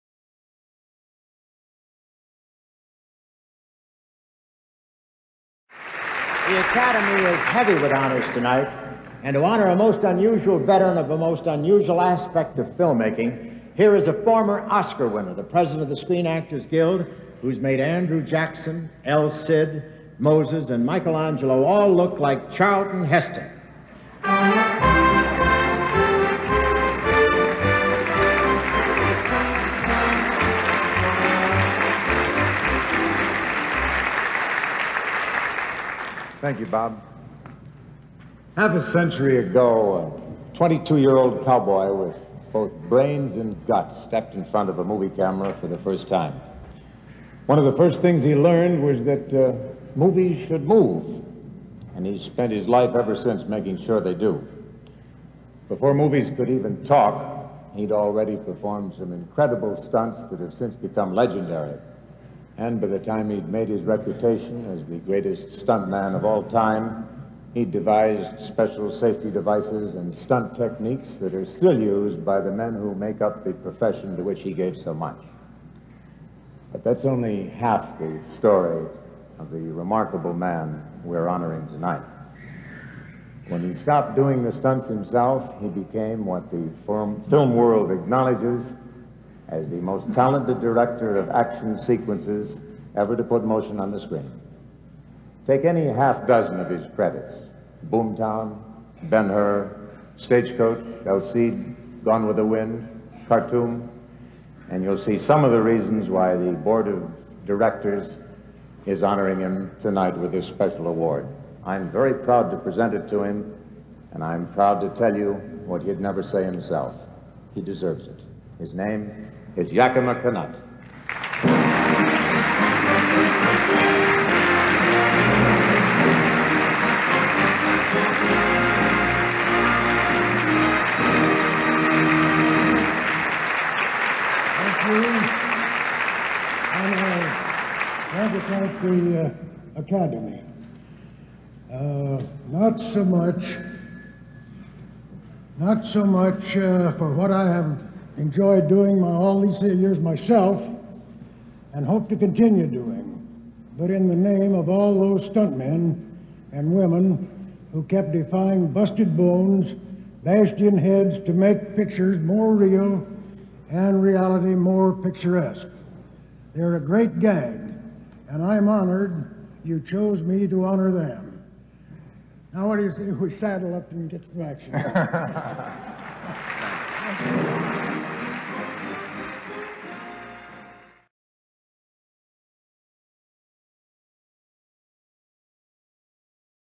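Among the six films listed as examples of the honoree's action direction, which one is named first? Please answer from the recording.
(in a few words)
Boomtown.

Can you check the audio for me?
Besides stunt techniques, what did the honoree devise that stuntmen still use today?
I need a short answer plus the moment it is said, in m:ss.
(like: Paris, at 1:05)
Special safety devices, at 1:08.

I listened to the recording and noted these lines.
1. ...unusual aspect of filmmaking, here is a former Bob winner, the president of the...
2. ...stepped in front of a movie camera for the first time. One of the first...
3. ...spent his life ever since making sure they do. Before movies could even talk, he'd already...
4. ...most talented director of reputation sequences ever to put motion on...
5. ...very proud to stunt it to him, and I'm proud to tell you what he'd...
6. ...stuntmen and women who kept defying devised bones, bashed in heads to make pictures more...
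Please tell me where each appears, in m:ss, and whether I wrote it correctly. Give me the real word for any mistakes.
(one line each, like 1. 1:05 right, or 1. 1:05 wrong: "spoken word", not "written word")
1. 0:11 wrong: "Oscar", not "Bob"
2. 0:44 right
3. 0:52 right
4. 1:29 wrong: "action", not "reputation"
5. 1:51 wrong: "present", not "stunt"
6. 2:35 wrong: "busted", not "devised".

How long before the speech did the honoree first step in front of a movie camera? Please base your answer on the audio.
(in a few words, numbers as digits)
Half a century.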